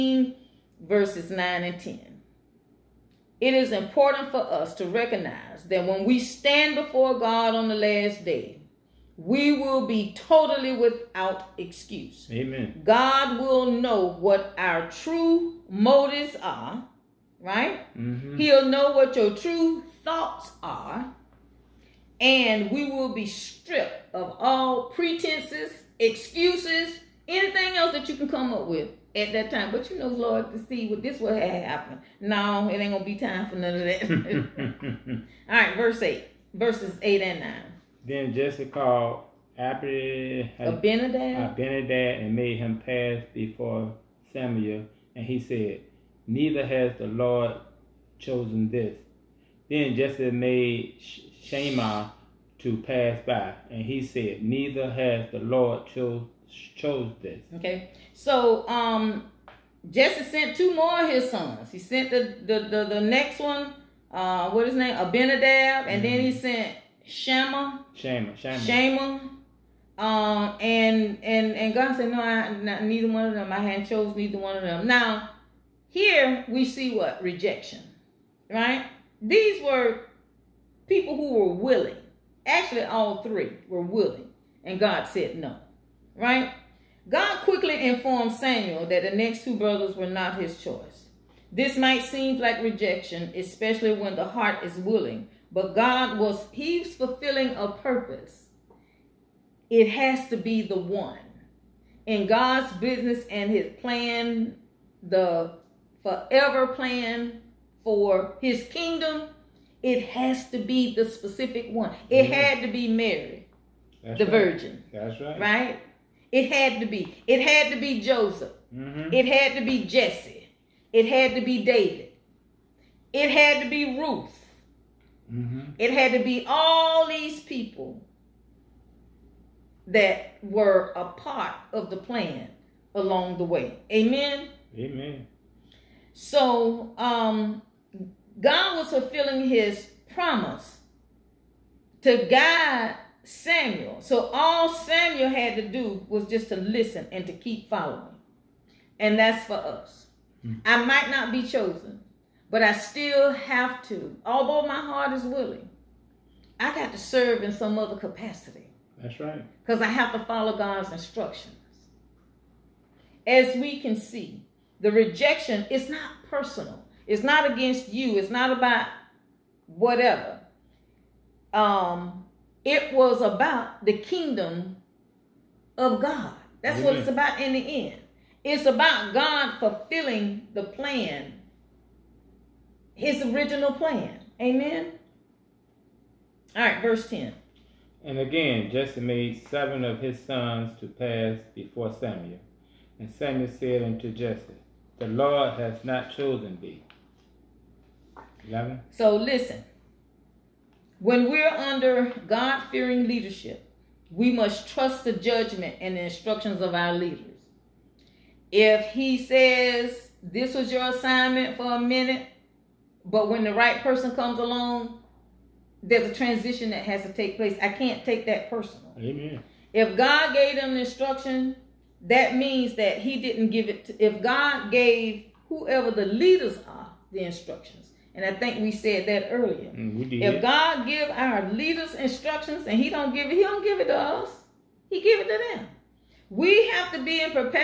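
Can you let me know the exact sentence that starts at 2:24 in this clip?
So all Samuel had to do was just to listen and to keep following.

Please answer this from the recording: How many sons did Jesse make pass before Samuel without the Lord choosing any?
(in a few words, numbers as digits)
7.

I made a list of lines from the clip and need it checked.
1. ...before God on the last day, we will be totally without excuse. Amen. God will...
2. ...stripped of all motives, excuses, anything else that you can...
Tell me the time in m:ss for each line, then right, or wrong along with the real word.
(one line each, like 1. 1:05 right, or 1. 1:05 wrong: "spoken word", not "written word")
1. 0:06 right
2. 0:23 wrong: "pretenses", not "motives".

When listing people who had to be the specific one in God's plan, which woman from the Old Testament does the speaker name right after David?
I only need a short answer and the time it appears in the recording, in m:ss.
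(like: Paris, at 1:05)
Ruth, at 2:03.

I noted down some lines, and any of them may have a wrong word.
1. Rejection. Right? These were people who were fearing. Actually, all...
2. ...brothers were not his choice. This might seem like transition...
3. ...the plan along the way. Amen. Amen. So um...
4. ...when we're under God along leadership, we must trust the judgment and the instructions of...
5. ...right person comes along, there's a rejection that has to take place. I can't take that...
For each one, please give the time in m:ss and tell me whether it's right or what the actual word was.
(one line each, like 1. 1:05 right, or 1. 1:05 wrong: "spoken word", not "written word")
1. 1:17 wrong: "willing", not "fearing"
2. 1:29 wrong: "rejection", not "transition"
3. 2:11 right
4. 3:21 wrong: "fearing", not "along"
5. 3:33 wrong: "transition", not "rejection".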